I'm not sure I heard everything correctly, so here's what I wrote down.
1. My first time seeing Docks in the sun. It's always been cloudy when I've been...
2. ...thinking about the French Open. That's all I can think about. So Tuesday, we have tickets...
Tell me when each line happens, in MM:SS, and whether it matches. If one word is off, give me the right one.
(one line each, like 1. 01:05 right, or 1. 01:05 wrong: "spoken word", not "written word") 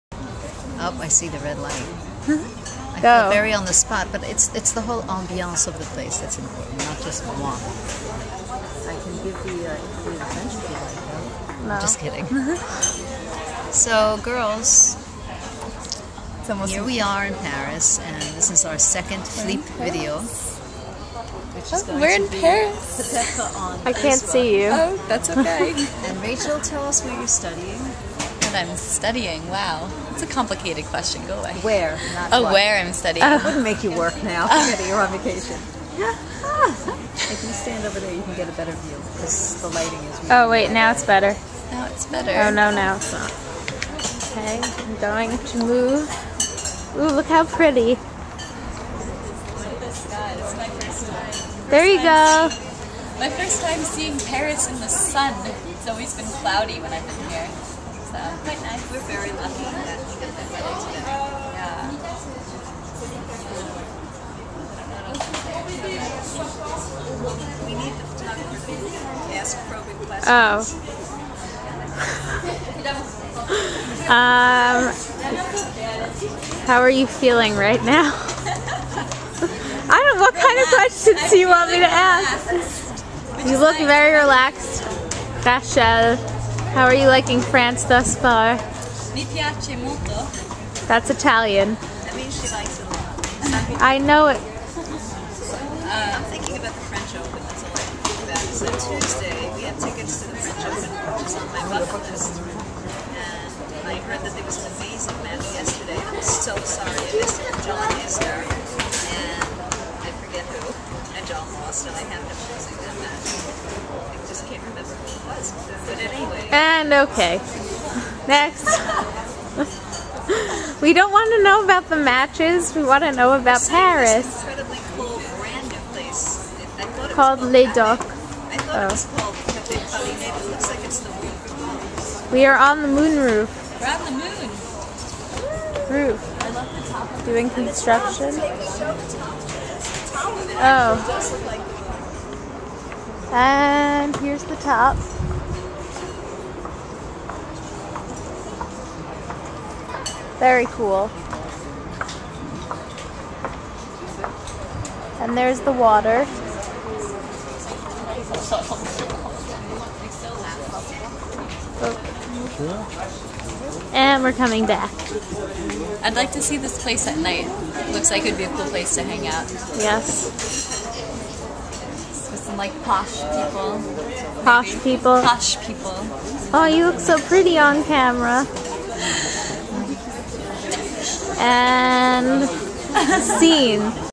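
1. 00:53 wrong: "Paris", not "Docks"
2. 01:36 right.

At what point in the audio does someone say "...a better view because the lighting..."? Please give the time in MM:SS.
00:38.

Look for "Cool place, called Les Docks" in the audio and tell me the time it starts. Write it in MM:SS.
02:04.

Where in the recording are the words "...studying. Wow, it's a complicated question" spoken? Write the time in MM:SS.
00:28.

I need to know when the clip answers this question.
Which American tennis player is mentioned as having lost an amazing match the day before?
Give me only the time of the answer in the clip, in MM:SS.
01:47.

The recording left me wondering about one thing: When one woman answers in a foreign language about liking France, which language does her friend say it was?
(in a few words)
Italian.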